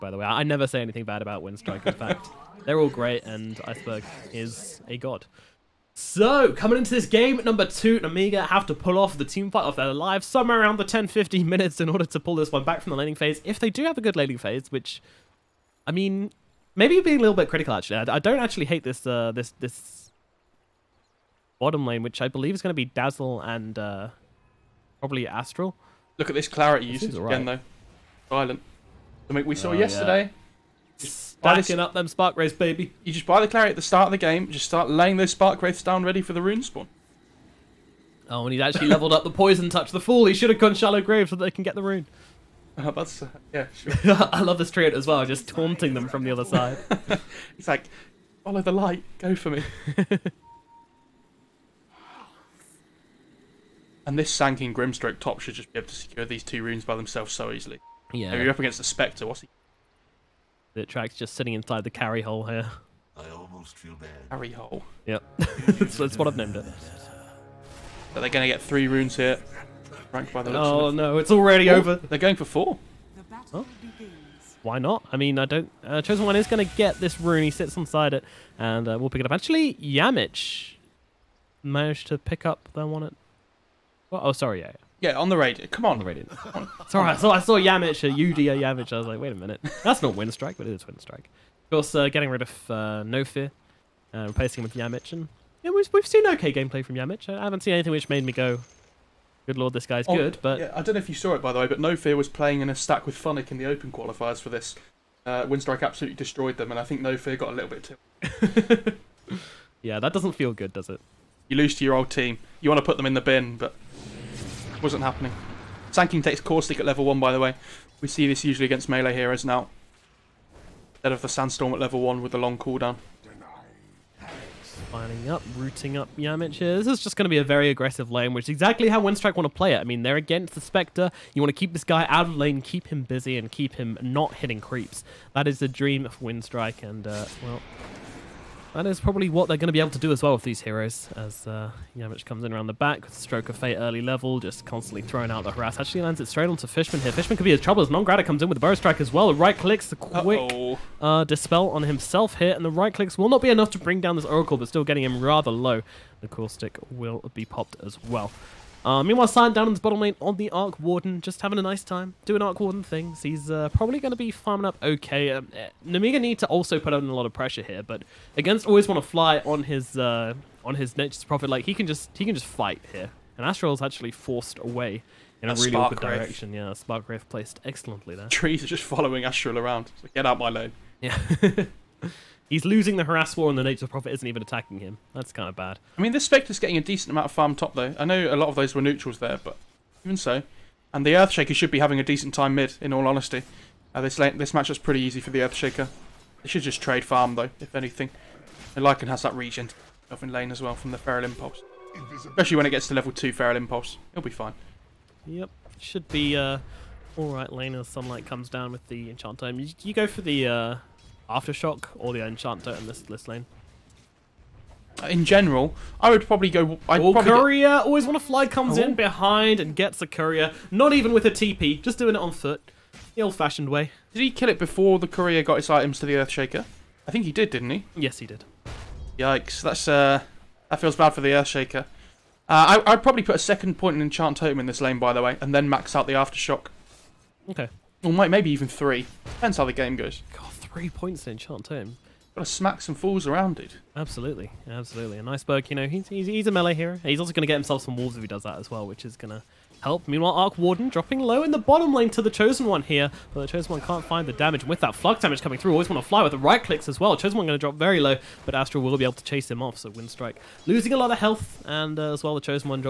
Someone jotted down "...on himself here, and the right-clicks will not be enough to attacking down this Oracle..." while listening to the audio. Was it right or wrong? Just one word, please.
wrong.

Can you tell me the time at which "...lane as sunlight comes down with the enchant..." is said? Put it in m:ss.
3:27.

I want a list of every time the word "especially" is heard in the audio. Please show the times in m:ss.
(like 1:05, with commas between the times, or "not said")
3:22.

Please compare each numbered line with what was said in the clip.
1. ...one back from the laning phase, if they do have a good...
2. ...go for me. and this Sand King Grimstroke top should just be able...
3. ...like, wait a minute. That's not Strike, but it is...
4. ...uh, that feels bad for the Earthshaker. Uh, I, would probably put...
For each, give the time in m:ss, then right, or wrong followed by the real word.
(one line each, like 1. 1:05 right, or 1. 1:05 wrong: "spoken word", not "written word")
1. 0:12 right
2. 0:49 right
3. 1:29 wrong: "Winstrike", not "Strike"
4. 3:49 right.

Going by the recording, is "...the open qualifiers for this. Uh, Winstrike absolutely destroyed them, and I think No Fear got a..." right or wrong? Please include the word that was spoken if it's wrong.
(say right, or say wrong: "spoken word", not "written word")
right.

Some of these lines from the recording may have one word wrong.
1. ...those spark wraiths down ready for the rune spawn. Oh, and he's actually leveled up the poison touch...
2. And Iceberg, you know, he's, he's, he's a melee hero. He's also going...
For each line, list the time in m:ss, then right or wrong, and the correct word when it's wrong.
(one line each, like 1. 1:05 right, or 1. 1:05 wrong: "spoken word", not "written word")
1. 0:35 right
2. 4:05 right.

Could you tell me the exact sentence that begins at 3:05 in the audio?
I mean, this Spectre's getting a decent amount of farm top though.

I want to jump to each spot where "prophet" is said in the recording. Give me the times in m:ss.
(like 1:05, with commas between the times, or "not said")
2:51, 3:03.